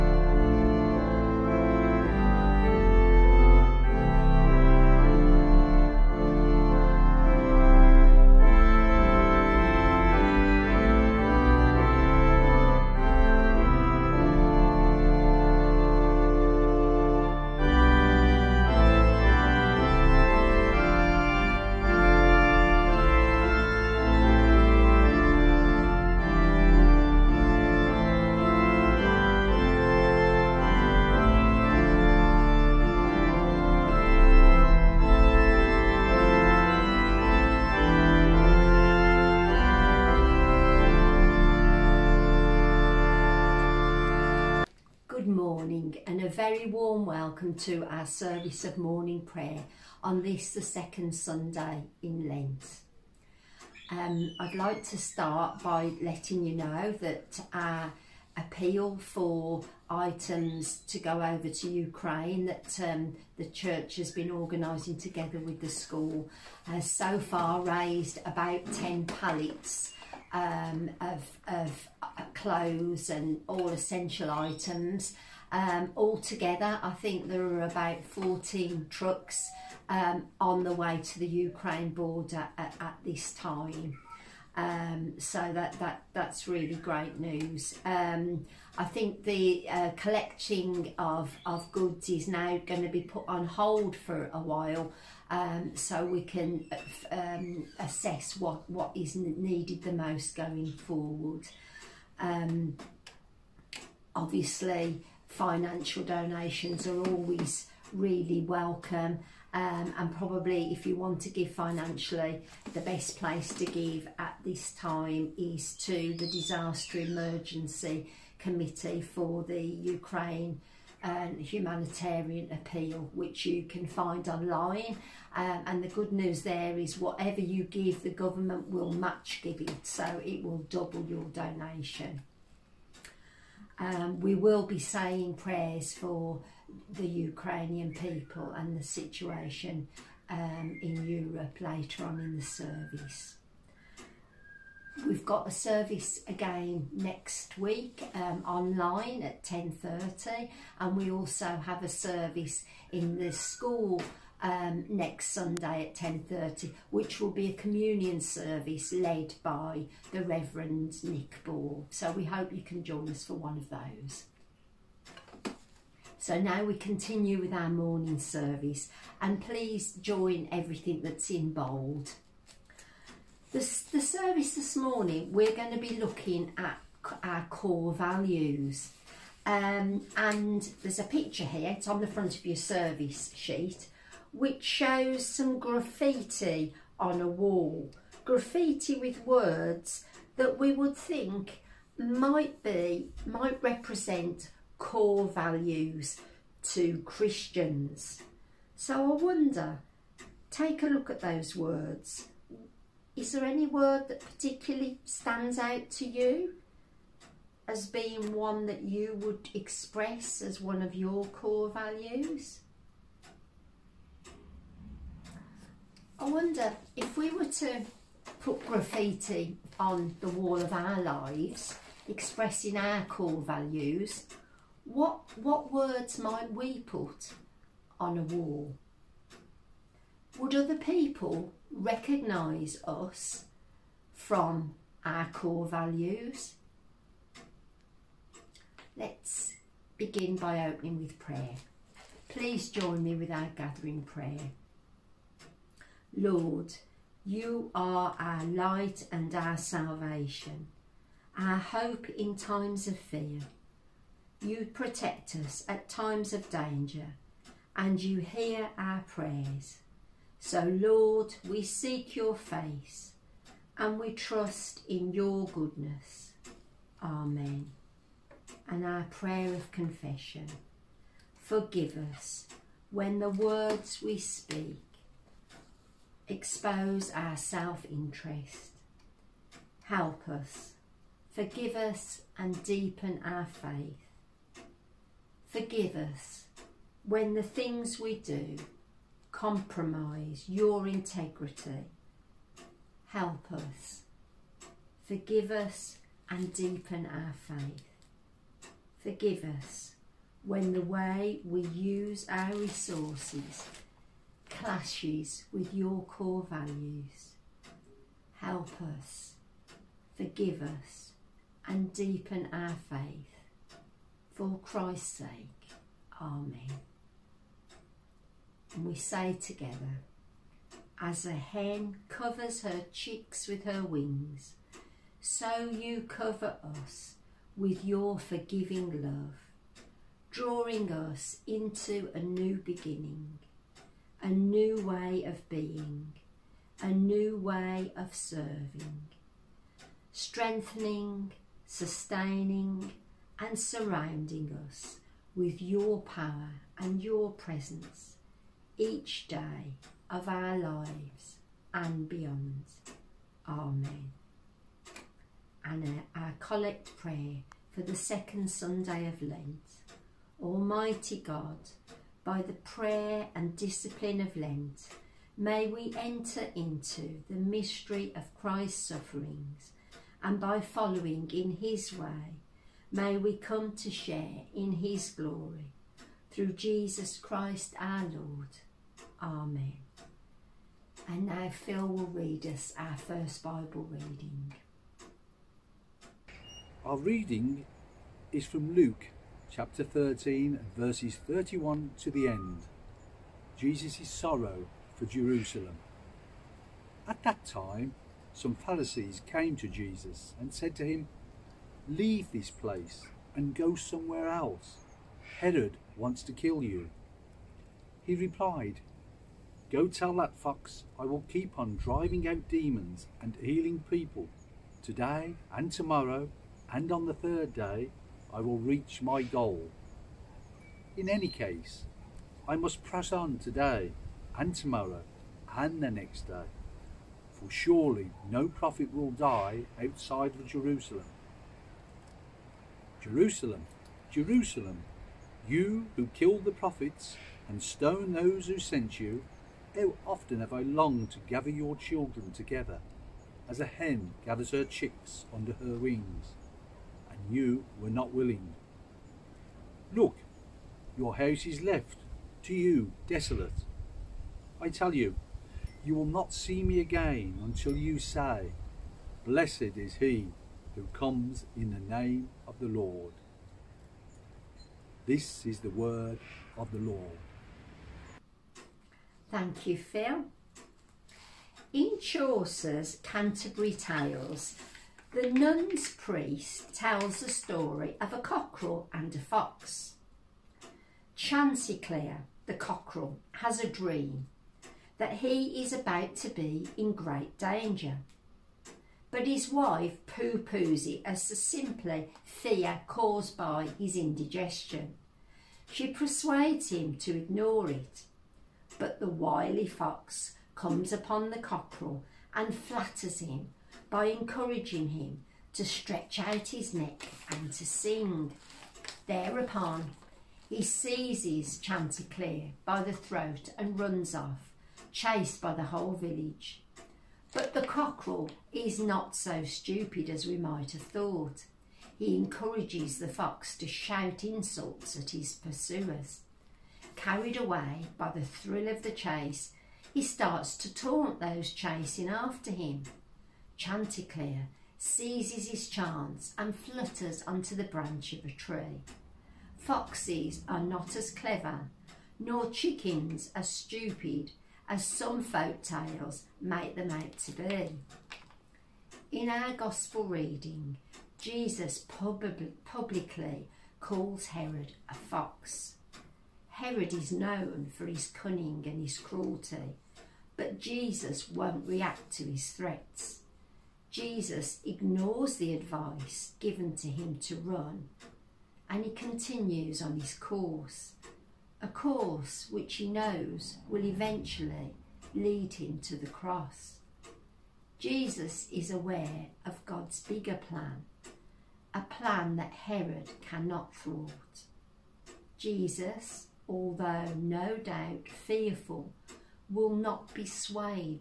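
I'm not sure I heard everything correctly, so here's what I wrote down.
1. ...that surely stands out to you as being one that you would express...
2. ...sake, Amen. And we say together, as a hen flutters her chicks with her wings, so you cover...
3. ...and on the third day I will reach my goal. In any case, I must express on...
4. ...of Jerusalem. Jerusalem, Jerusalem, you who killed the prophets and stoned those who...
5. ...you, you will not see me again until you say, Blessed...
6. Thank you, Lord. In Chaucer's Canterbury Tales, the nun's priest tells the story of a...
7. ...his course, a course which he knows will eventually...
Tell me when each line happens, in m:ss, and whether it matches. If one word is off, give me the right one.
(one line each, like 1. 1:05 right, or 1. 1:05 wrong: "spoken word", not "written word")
1. 3:24 wrong: "particularly", not "surely"
2. 5:15 wrong: "covers", not "flutters"
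3. 6:56 wrong: "press", not "express"
4. 7:10 right
5. 7:34 right
6. 7:49 wrong: "Phil", not "Lord"
7. 9:29 right.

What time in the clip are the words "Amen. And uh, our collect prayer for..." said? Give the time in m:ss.
5:53.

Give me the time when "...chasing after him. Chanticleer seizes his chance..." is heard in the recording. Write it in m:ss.
8:51.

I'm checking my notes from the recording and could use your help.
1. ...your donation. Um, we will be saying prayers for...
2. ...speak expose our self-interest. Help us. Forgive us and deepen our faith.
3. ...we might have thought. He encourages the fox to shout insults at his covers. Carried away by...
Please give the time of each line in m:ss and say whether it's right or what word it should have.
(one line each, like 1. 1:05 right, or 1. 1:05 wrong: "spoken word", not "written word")
1. 2:11 right
2. 4:34 right
3. 8:40 wrong: "pursuers", not "covers".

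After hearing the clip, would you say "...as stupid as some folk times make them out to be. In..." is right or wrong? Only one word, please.
wrong.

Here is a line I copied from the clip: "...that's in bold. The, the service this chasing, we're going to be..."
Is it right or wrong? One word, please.
wrong.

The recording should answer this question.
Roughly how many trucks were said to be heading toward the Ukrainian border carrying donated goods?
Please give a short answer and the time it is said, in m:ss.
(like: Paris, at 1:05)
14, at 1:18.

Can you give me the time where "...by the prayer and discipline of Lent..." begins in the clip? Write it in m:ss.
6:02.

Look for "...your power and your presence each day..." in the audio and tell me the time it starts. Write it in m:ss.
5:45.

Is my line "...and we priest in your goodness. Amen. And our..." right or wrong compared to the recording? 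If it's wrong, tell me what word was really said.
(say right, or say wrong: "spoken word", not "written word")
wrong: "trust", not "priest".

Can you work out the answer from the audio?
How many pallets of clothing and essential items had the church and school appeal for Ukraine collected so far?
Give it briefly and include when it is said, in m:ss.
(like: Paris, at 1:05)
10, at 1:08.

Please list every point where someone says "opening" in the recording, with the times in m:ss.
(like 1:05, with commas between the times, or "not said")
4:00.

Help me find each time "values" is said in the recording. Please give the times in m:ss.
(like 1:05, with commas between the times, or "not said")
2:57, 3:15, 3:31, 3:43, 3:55, 5:06.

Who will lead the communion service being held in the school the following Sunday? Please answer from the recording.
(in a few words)
Reverend Nick Ball.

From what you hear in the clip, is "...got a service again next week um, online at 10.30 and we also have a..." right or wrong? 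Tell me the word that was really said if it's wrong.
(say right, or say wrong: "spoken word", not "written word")
right.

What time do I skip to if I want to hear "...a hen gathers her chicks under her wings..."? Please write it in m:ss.
7:23.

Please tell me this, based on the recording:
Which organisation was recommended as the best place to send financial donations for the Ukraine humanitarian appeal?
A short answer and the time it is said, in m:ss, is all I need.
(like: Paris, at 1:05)
Disaster Emergency Committee, at 1:56.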